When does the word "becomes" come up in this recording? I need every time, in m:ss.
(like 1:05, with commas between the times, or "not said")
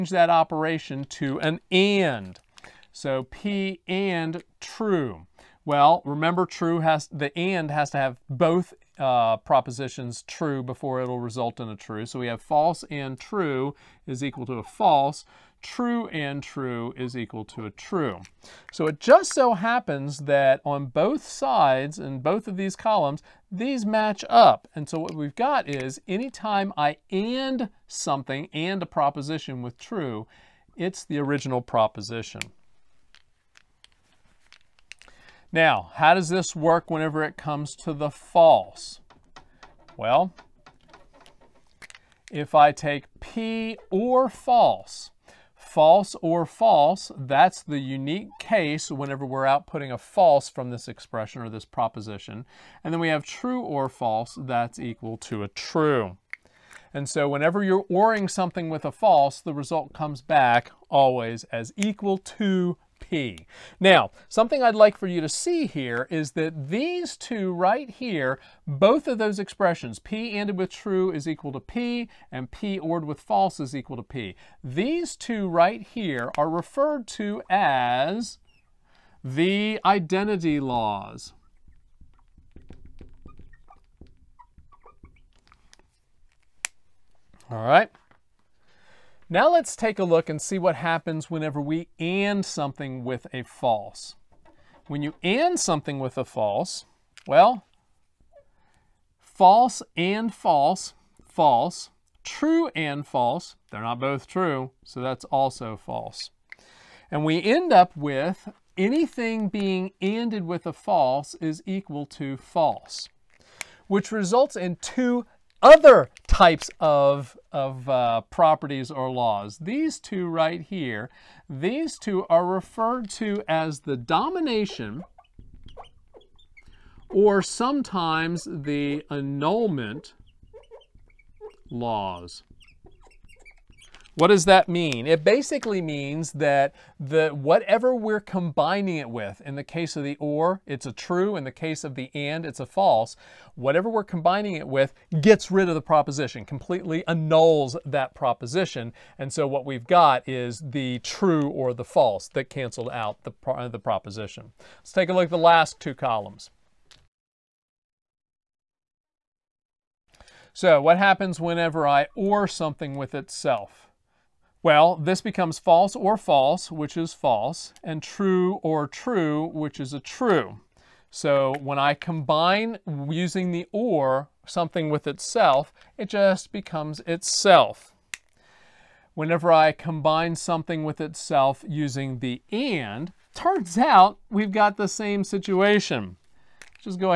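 2:45, 2:56.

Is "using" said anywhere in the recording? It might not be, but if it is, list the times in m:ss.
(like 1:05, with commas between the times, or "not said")
2:53, 3:01.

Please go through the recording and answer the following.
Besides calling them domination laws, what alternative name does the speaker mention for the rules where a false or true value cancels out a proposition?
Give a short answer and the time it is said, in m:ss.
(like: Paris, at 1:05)
annulment laws, at 2:09.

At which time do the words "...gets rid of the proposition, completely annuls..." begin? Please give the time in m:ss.
2:25.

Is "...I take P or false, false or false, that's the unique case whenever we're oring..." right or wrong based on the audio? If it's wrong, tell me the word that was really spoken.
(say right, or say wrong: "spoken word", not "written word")
wrong: "outputting", not "oring".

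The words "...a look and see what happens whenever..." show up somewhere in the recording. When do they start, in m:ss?
1:29.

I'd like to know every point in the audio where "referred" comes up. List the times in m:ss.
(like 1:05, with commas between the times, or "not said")
1:16, 2:02.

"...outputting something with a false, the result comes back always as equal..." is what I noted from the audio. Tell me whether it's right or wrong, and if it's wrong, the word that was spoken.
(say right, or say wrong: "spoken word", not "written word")
wrong: "oring", not "outputting".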